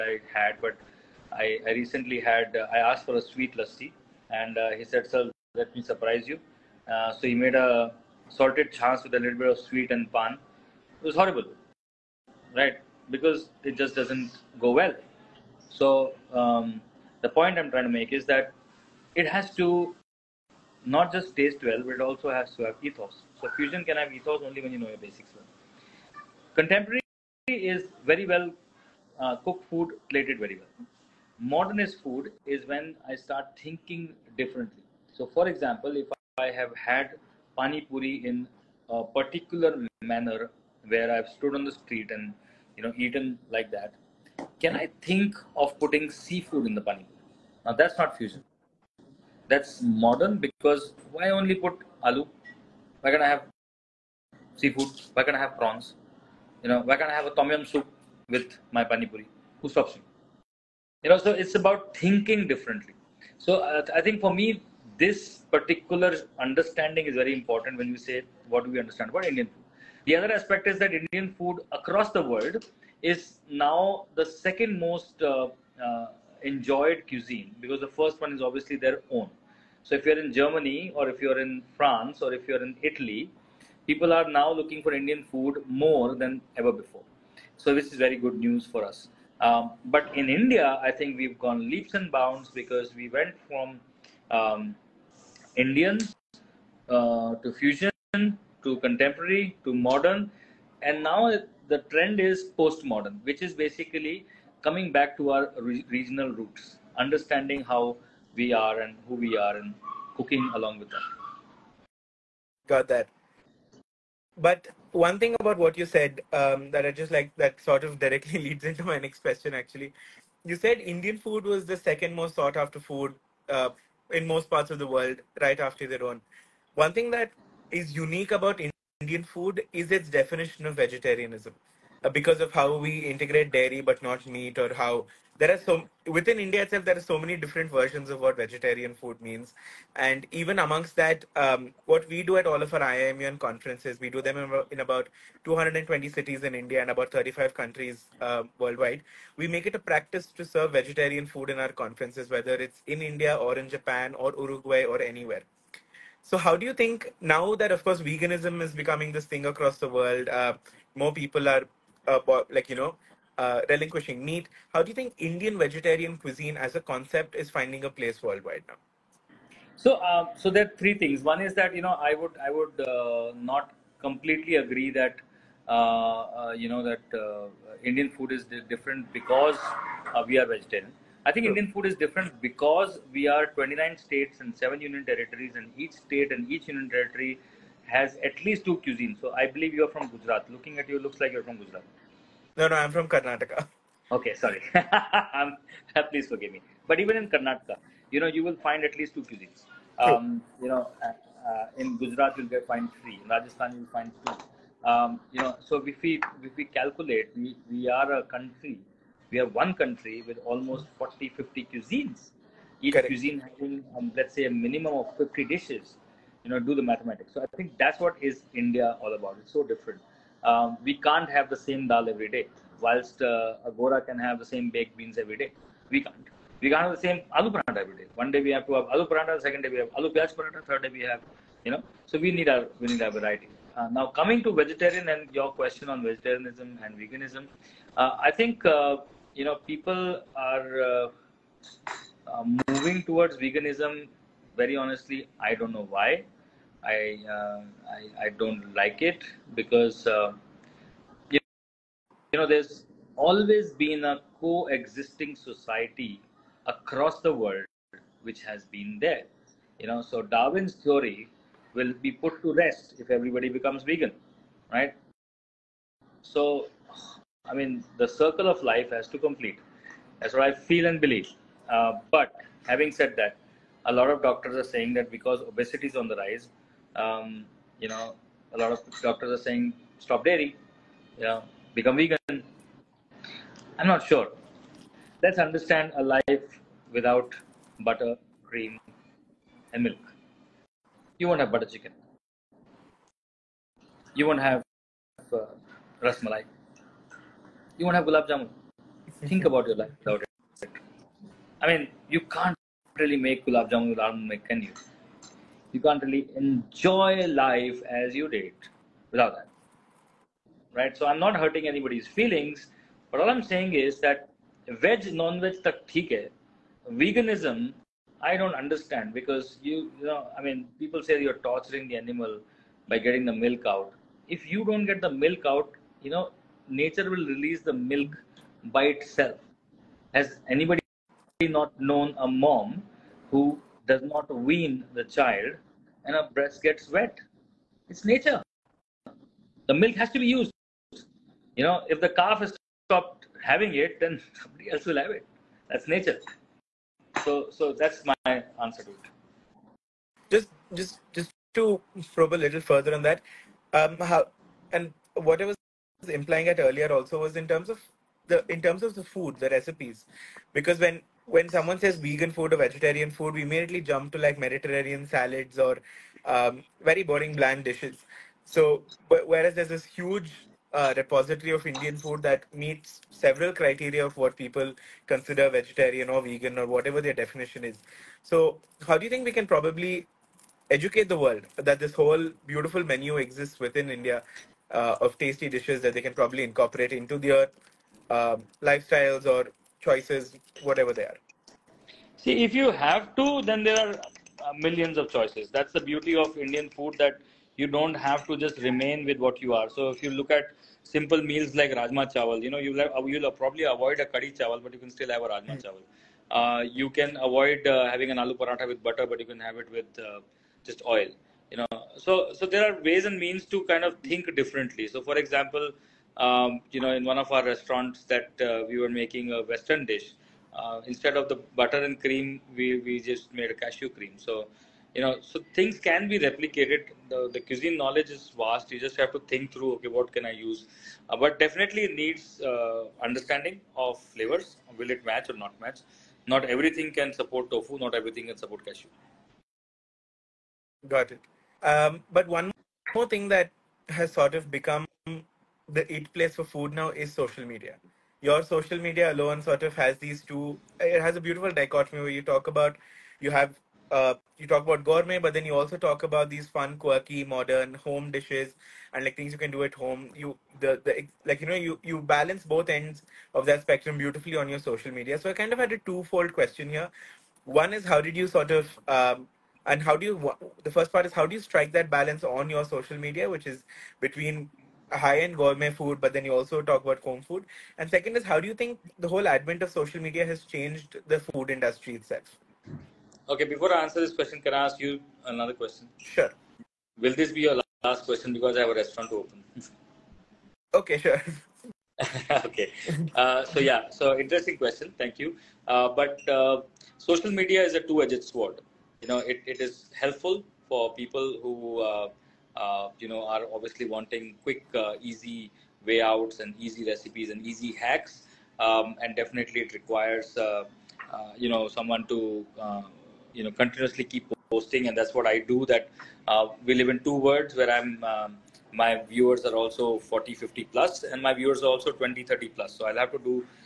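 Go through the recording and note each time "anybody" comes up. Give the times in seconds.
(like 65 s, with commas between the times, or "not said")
311 s, 330 s.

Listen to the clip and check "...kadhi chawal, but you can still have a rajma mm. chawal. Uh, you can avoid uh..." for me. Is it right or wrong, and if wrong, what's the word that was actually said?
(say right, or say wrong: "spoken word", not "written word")
right.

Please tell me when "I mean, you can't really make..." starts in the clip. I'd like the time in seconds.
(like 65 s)
301 s.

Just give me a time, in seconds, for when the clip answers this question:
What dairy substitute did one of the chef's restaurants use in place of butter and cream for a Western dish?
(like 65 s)
423 s.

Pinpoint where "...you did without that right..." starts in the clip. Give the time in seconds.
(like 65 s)
308 s.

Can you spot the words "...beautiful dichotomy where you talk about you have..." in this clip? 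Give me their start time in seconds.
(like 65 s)
451 s.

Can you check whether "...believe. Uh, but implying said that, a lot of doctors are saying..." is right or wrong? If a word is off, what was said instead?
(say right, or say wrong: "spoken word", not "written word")
wrong: "having", not "implying".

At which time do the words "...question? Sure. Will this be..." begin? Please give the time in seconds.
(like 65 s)
485 s.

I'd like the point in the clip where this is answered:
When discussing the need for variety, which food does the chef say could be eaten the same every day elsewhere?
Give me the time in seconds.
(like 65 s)
224 s.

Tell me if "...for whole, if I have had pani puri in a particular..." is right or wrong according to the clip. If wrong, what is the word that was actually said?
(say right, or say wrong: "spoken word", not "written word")
wrong: "example", not "whole".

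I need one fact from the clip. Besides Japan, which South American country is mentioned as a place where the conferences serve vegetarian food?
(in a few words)
Uruguay.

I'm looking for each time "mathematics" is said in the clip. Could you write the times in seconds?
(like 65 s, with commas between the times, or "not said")
216 s.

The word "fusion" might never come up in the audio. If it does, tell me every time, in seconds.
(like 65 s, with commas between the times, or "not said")
23 s, 48 s, 97 s.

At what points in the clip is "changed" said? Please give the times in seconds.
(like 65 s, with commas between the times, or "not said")
480 s.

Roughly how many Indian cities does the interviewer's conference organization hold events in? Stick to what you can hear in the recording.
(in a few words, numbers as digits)
220.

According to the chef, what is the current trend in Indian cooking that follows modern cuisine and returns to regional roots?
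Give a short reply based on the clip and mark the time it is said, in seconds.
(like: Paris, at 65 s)
Postmodern, at 102 s.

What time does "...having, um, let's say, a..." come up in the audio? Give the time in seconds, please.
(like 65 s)
213 s.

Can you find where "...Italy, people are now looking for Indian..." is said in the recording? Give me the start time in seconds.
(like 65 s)
82 s.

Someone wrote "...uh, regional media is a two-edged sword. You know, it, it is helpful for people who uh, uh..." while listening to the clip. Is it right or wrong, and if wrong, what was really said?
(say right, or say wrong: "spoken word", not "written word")
wrong: "social", not "regional".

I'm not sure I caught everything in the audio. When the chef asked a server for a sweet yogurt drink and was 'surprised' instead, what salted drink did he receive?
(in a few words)
Salted chaas.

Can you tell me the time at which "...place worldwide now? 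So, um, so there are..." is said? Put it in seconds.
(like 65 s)
167 s.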